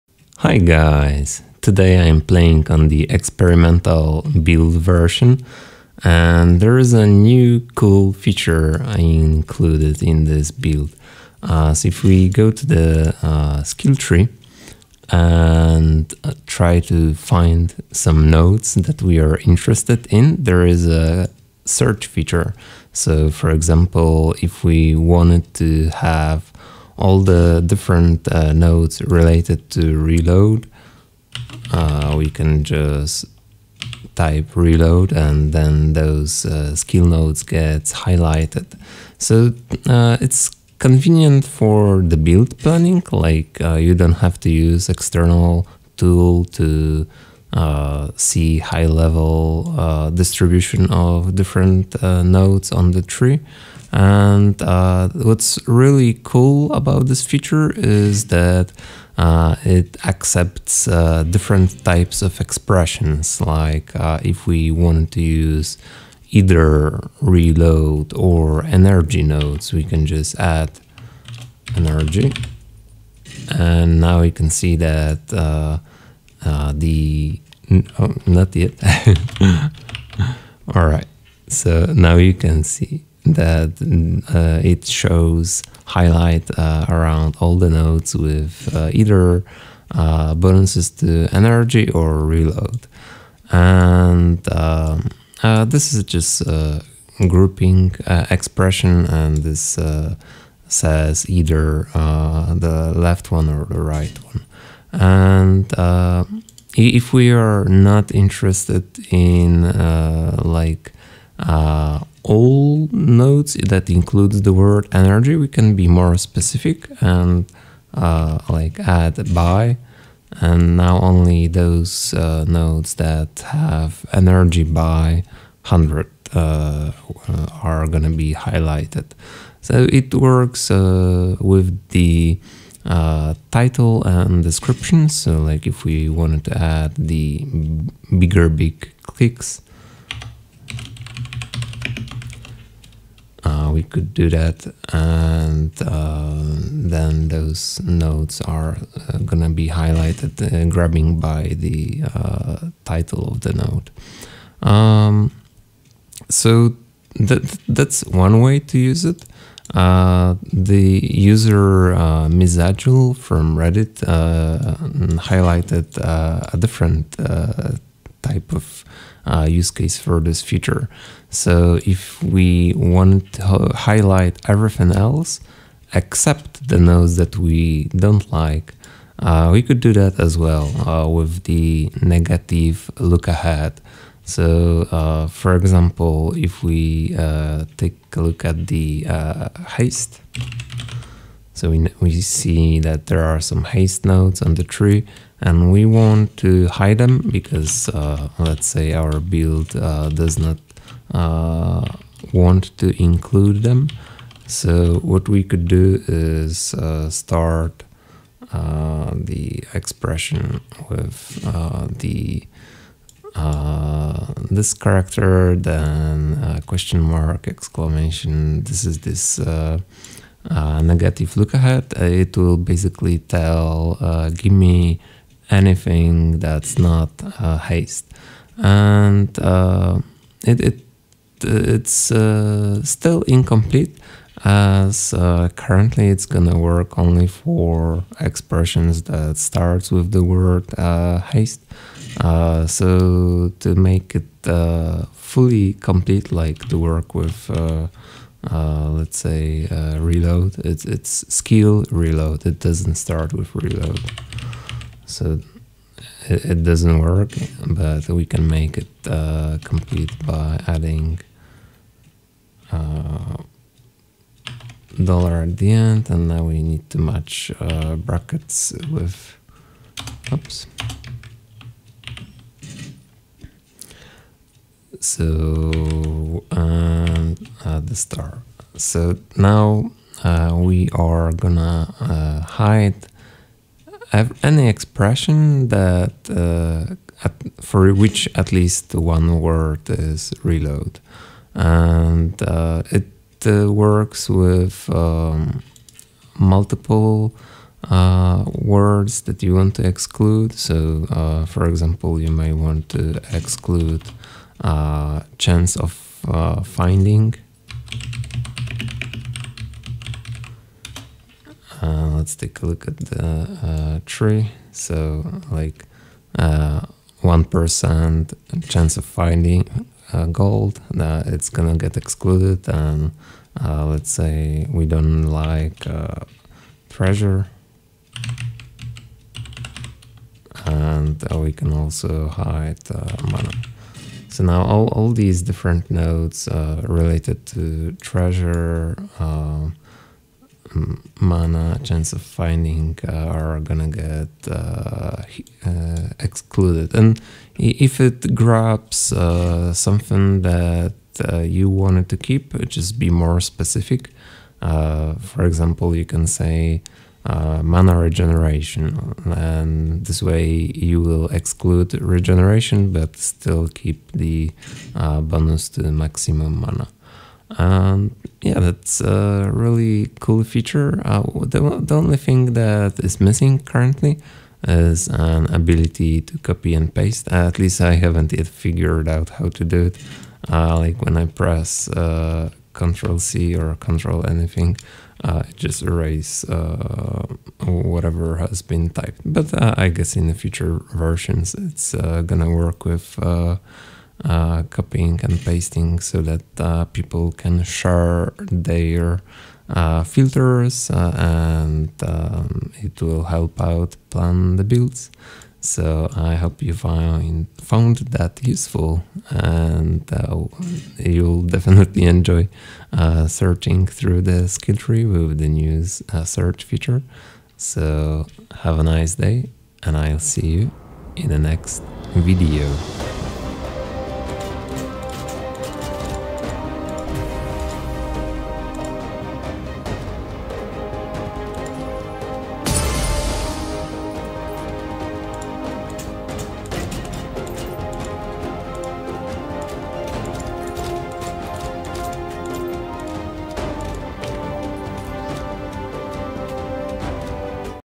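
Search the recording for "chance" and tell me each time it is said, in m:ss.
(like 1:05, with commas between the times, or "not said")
5:05, 5:18, 5:41.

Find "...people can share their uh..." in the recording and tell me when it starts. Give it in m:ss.
6:36.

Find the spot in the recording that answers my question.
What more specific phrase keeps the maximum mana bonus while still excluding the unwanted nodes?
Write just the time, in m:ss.
5:57.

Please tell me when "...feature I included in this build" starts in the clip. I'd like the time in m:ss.
0:08.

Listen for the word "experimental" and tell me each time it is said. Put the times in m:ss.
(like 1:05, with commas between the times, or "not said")
0:03.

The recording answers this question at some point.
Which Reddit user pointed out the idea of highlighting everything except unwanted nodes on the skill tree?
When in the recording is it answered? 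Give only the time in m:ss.
2:42.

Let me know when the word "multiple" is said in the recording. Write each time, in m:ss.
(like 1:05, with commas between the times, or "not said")
4:56.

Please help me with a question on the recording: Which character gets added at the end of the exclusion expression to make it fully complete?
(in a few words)
dollar.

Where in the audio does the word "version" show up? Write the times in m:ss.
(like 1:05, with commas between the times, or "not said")
0:04, 6:30.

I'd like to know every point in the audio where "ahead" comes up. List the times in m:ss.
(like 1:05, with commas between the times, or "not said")
3:03, 3:41.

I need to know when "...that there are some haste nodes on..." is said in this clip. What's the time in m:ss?
3:12.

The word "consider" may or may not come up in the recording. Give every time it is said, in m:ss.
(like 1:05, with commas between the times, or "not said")
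not said.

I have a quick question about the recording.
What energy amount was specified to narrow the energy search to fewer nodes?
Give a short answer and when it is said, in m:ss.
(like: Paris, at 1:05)
100, at 2:05.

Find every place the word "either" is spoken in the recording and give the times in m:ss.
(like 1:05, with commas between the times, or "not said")
1:06, 1:28, 1:41.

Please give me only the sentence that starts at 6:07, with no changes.
Um, yeah, that's a really cool feature.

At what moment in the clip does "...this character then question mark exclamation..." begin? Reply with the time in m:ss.
3:34.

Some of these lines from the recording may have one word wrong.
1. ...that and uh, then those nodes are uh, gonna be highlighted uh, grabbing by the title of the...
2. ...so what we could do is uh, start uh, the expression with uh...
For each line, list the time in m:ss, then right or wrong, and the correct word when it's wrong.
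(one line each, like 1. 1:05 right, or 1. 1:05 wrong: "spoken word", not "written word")
1. 2:24 right
2. 3:24 right.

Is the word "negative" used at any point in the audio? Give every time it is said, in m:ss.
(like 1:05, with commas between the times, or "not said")
3:02, 3:40.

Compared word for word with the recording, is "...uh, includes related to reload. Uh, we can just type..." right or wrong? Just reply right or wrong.
wrong.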